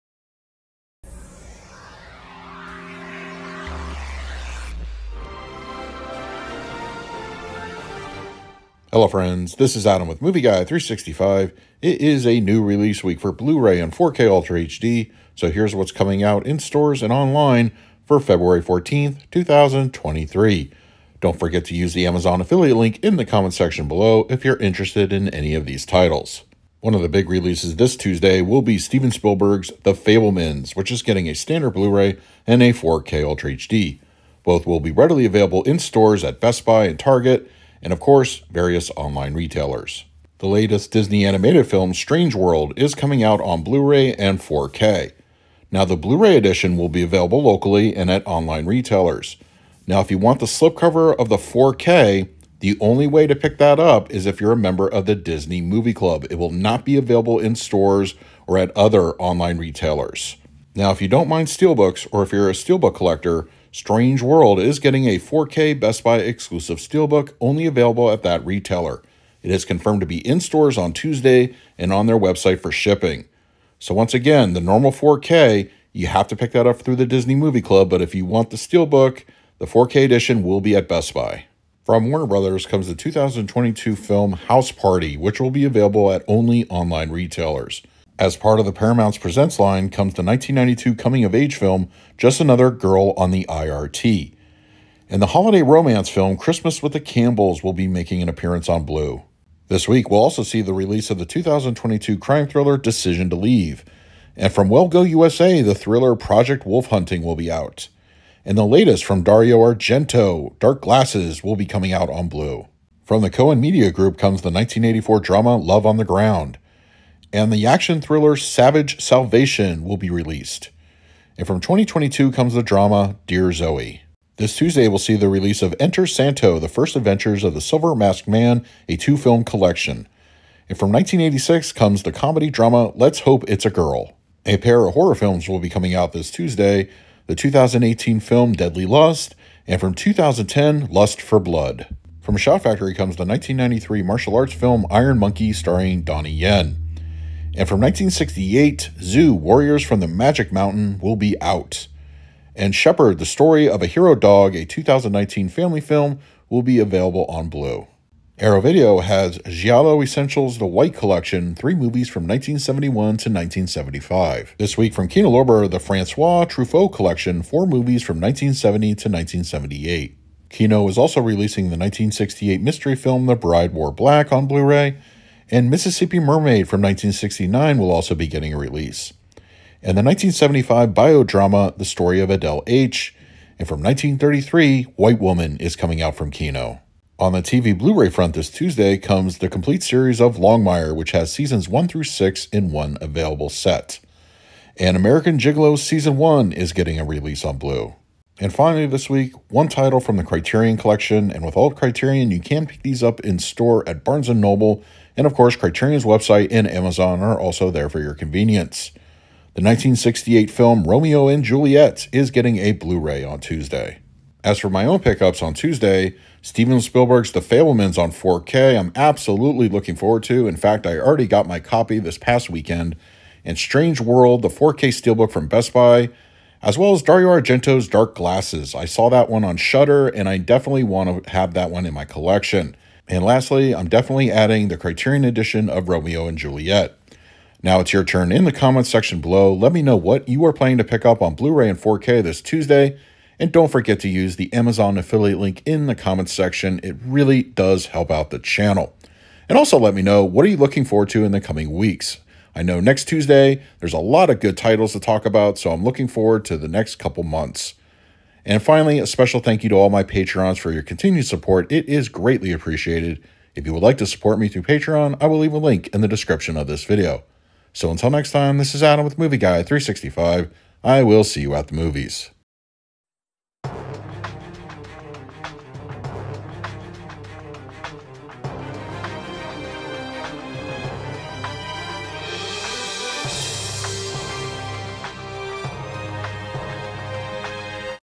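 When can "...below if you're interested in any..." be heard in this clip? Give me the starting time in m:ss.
0:23.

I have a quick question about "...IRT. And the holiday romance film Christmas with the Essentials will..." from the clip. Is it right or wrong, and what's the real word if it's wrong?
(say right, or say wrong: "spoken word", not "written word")
wrong: "Campbells", not "Essentials".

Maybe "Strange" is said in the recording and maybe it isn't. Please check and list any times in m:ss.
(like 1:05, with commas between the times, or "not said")
0:41, 1:03, 3:43.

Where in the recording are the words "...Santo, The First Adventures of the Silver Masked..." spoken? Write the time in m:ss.
2:06.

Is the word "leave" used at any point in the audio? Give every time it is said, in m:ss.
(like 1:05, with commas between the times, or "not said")
1:43, 4:25.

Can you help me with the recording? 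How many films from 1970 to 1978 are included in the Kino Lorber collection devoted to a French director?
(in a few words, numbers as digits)
4.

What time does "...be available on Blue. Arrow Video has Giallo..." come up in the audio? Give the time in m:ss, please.
2:36.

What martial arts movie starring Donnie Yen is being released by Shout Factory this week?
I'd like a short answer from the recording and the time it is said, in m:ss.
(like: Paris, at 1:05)
Iron Monkey, at 2:24.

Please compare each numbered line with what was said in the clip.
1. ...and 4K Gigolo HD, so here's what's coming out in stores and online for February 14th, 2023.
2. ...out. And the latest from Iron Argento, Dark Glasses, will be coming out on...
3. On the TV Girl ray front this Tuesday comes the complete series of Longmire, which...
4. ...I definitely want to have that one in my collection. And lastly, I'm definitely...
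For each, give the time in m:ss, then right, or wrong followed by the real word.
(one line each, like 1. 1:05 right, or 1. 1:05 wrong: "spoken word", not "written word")
1. 0:13 wrong: "Ultra", not "Gigolo"
2. 1:47 wrong: "Dario", not "Iron"
3. 3:07 wrong: "Blu", not "Girl"
4. 3:50 right.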